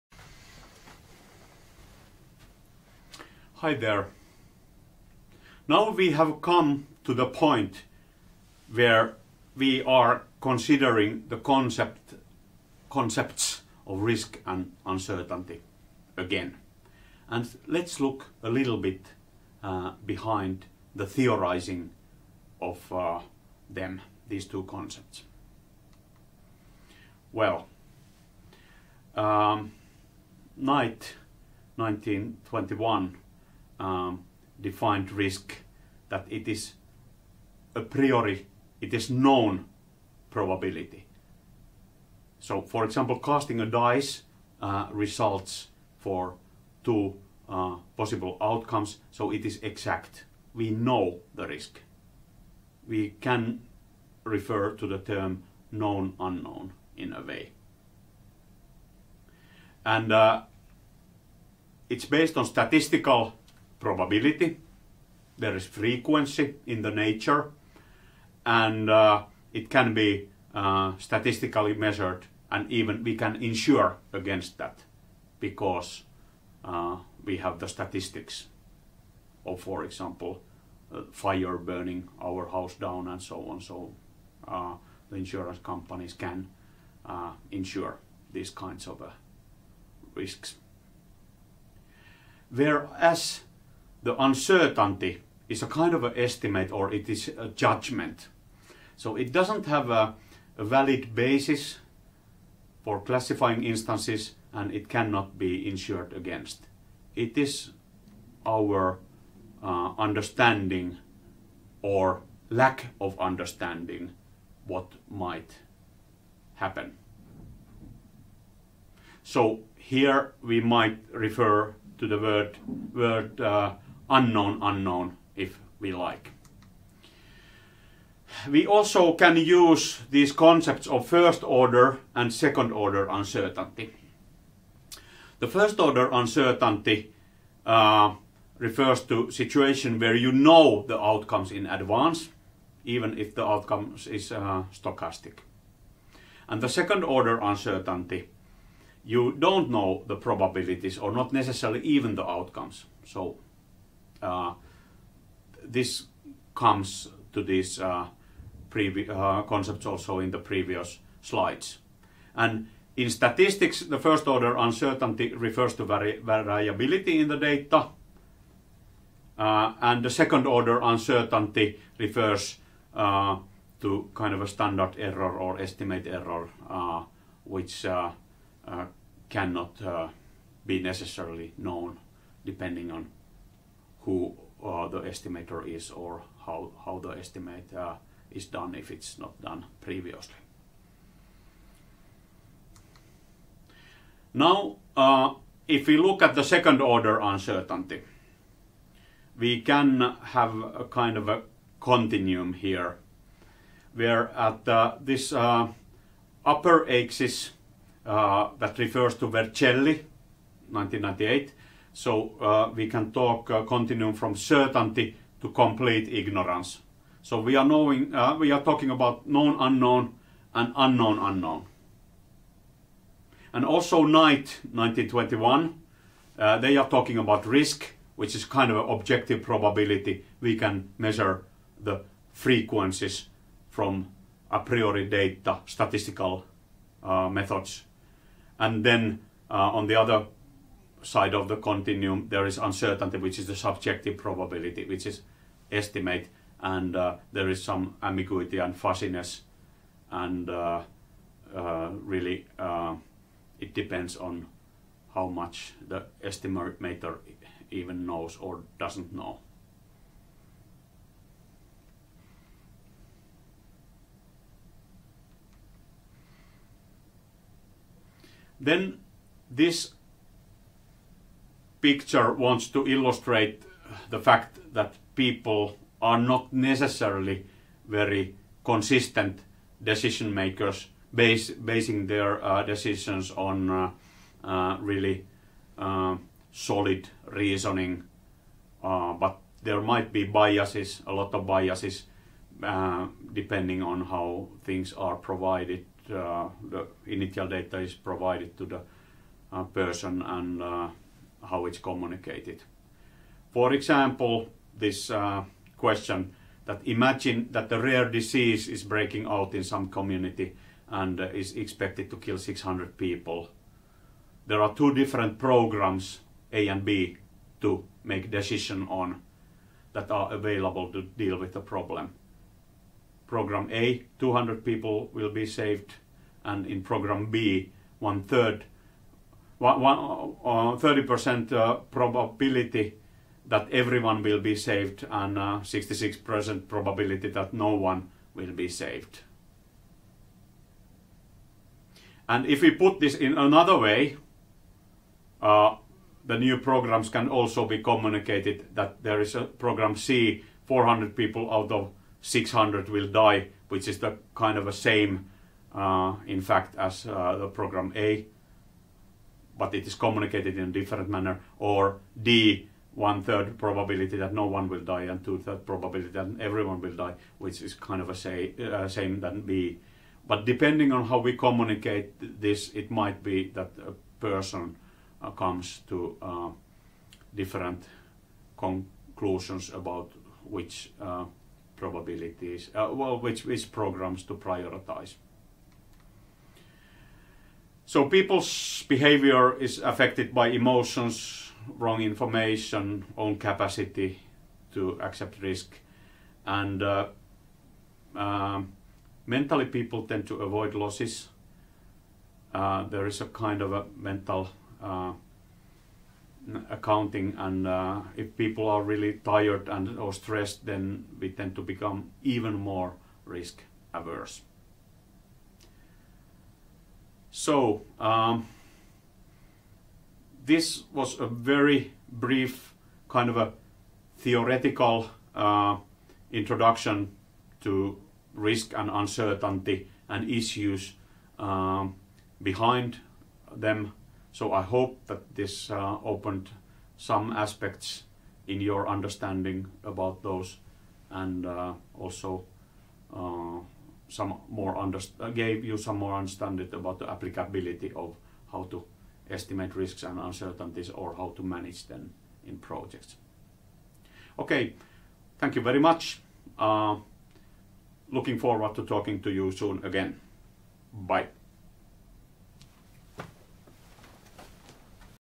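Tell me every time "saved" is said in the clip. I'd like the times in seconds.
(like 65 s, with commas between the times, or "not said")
325 s, 334 s, 338 s.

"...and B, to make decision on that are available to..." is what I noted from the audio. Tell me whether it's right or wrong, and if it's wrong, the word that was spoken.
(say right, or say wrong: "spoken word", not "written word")
right.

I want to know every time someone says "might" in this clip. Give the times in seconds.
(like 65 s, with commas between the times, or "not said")
115 s, 120 s, 289 s, 372 s.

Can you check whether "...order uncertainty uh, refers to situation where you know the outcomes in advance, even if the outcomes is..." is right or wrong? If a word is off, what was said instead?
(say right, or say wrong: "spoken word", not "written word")
right.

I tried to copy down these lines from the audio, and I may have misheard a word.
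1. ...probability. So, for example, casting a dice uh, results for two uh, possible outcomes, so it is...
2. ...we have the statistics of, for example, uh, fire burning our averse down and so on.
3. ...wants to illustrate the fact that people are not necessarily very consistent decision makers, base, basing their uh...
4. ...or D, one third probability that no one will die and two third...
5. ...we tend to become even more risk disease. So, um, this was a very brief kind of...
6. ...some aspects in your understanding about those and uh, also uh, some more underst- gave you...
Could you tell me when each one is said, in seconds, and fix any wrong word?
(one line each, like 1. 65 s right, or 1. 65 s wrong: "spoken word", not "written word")
1. 40 s right
2. 77 s wrong: "house", not "averse"
3. 272 s right
4. 361 s right
5. 411 s wrong: "averse", not "disease"
6. 436 s right.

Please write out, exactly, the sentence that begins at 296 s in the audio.
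the initial data is provided to the person and how it's communicated.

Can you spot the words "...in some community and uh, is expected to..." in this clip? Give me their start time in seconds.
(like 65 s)
309 s.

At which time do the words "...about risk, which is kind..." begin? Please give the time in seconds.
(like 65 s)
227 s.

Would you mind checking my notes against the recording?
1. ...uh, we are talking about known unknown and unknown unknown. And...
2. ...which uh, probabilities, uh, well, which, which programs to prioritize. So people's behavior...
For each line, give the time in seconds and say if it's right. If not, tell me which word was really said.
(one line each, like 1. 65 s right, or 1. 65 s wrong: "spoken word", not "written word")
1. 218 s right
2. 380 s right.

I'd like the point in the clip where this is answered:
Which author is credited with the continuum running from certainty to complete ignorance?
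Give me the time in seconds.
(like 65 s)
209 s.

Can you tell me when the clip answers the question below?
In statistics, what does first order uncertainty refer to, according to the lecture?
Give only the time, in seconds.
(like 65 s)
165 s.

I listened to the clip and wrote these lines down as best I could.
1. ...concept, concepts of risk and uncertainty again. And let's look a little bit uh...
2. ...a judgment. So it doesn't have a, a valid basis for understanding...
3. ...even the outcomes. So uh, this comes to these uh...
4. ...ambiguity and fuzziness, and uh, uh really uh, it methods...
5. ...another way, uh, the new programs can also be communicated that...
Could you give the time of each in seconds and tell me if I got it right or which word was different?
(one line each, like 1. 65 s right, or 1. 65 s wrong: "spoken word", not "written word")
1. 11 s right
2. 97 s wrong: "classifying", not "understanding"
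3. 151 s right
4. 248 s wrong: "depends", not "methods"
5. 343 s right.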